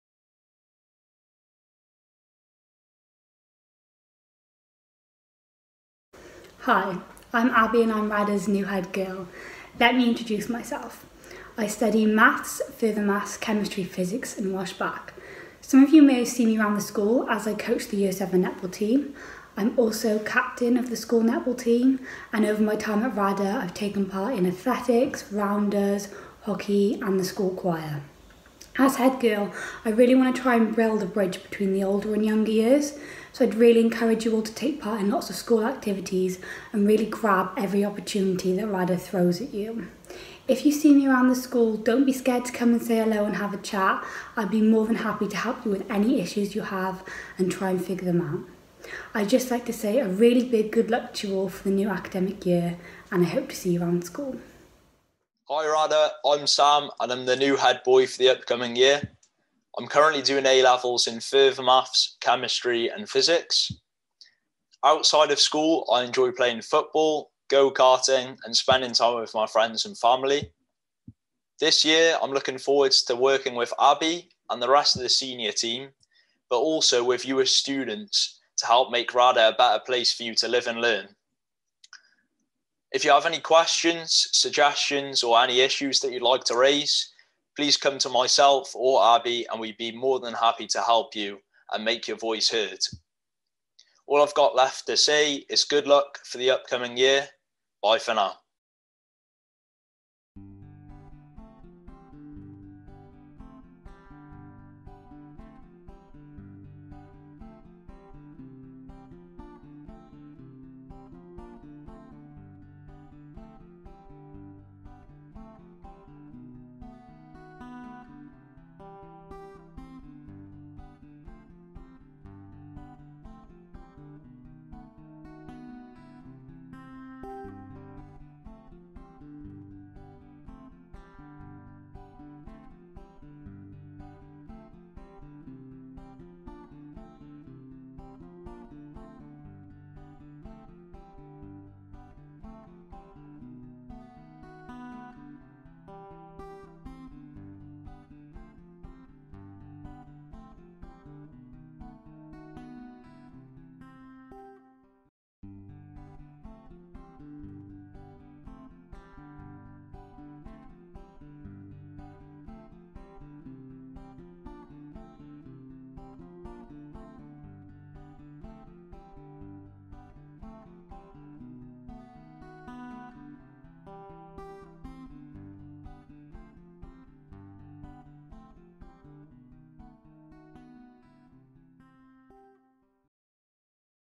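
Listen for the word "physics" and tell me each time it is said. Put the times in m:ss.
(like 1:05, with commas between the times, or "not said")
0:13, 1:03.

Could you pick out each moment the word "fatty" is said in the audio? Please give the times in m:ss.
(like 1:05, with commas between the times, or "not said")
not said.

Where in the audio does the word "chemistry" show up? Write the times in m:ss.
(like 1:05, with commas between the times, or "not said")
0:13, 1:02.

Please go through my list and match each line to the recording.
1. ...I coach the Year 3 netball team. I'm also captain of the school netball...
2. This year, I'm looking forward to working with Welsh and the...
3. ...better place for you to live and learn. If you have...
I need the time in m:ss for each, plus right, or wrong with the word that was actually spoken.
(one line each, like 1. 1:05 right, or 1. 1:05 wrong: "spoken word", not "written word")
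1. 0:17 wrong: "7", not "3"
2. 1:11 wrong: "Abby", not "Welsh"
3. 1:19 right.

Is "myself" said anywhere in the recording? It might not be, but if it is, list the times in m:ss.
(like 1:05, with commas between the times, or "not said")
0:10, 1:28.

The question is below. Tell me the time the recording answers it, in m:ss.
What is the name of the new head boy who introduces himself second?
0:56.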